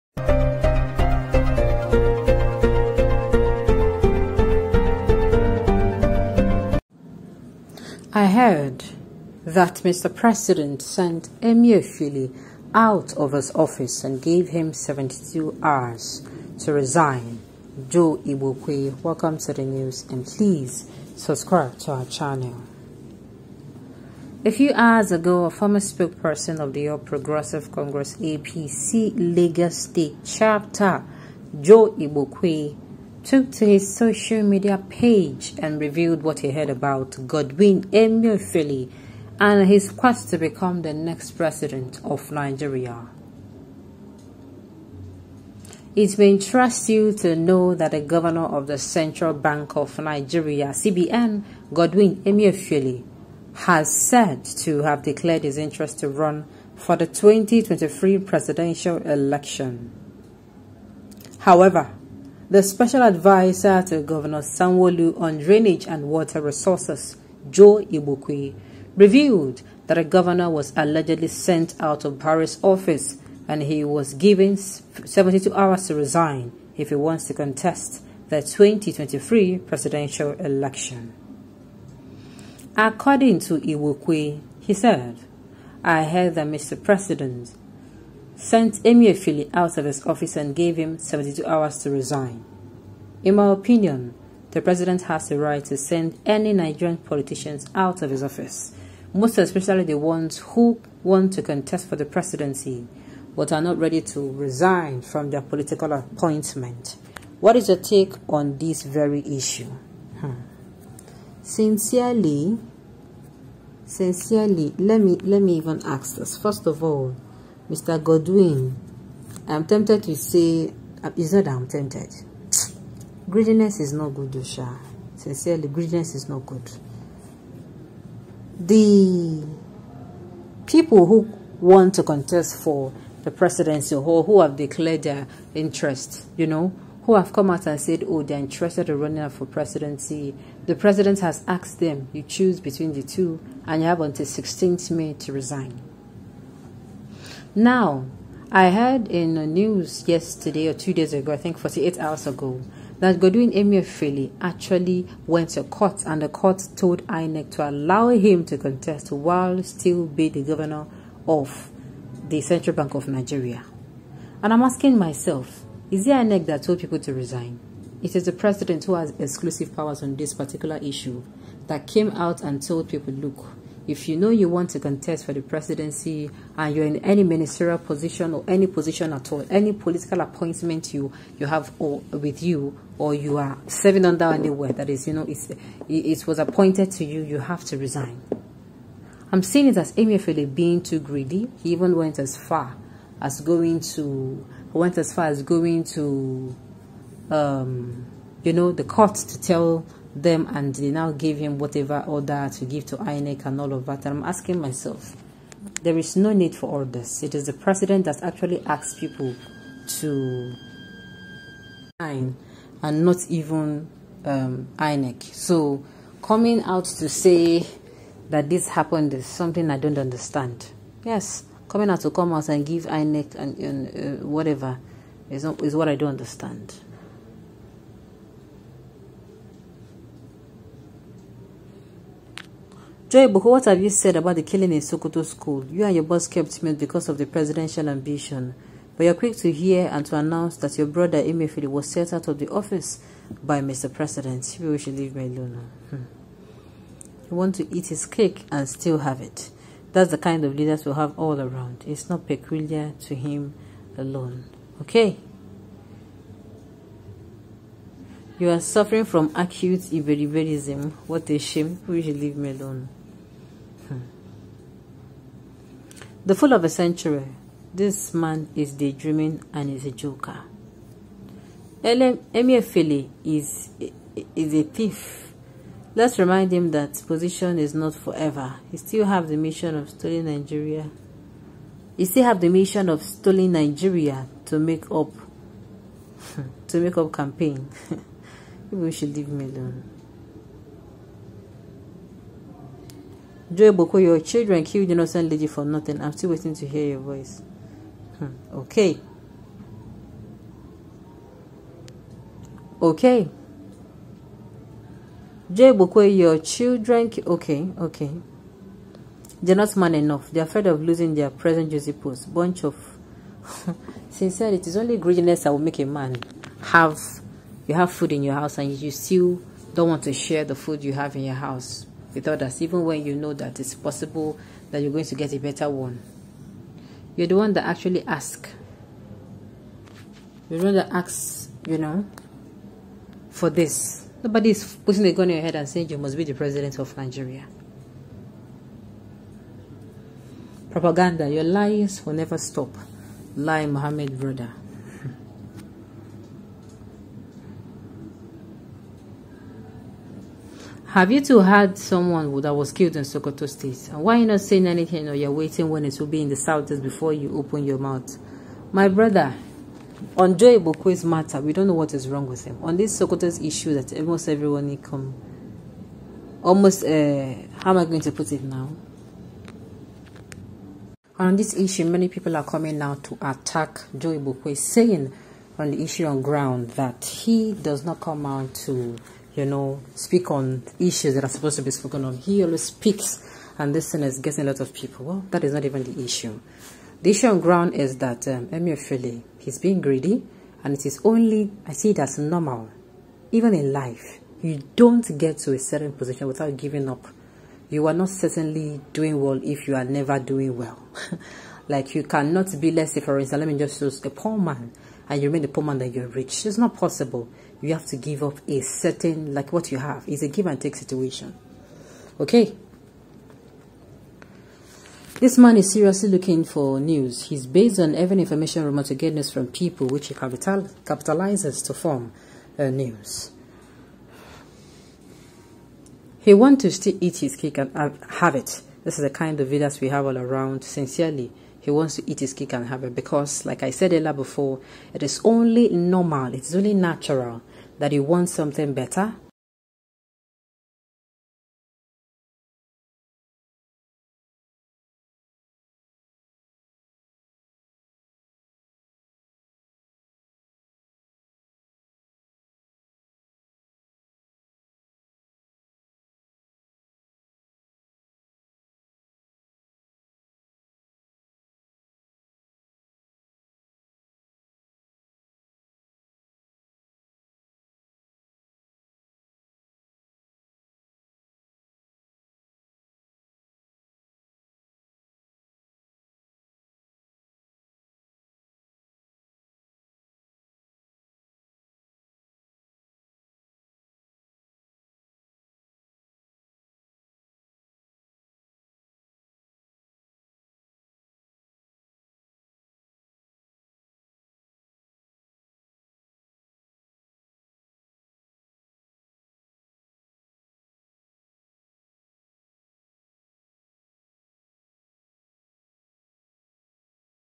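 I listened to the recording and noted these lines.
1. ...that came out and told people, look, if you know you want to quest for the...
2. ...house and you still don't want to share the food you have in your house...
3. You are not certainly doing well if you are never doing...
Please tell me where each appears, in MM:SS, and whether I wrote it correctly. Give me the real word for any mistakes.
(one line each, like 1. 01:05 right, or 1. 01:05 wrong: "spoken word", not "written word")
1. 02:51 wrong: "contest", not "quest"
2. 05:18 right
3. 06:37 right.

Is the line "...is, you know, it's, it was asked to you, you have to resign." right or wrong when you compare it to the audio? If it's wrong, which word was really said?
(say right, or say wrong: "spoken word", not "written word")
wrong: "appointed", not "asked".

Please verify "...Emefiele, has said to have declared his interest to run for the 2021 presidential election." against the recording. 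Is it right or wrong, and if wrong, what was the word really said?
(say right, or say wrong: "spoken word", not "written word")
wrong: "2023", not "2021".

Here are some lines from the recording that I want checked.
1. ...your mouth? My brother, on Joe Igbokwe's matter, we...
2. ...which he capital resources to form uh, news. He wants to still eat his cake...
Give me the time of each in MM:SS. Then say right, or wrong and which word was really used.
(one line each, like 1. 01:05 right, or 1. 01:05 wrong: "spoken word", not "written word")
1. 05:57 right
2. 06:59 wrong: "capitalizes", not "resources".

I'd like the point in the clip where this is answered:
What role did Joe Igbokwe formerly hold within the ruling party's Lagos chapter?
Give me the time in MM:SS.
00:25.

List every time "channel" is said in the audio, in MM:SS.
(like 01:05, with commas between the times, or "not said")
00:22.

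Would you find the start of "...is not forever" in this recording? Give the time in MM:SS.
04:37.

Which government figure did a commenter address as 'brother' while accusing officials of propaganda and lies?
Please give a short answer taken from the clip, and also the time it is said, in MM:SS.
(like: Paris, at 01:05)
Lai Mohammed, at 05:43.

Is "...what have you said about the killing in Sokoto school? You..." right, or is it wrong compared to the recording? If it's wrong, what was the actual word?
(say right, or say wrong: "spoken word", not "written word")
right.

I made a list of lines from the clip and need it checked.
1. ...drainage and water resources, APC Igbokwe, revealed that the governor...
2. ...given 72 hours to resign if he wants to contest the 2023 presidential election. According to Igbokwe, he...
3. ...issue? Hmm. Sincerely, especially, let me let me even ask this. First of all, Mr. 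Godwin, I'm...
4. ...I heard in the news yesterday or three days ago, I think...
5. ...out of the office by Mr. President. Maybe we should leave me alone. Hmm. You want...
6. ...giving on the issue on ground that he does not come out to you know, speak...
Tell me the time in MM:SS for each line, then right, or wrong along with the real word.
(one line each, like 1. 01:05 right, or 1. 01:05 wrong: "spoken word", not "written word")
1. 01:05 wrong: "Joe", not "APC"
2. 01:14 right
3. 01:49 wrong: "sincerely", not "especially"
4. 02:28 wrong: "two", not "three"
5. 04:02 right
6. 06:14 wrong: "saying", not "giving".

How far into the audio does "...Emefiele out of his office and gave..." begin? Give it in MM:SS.
01:28.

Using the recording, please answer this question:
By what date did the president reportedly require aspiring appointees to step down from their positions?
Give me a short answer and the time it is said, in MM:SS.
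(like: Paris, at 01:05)
16th May, at 02:24.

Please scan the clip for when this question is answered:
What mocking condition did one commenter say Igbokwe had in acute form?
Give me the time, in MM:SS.
04:19.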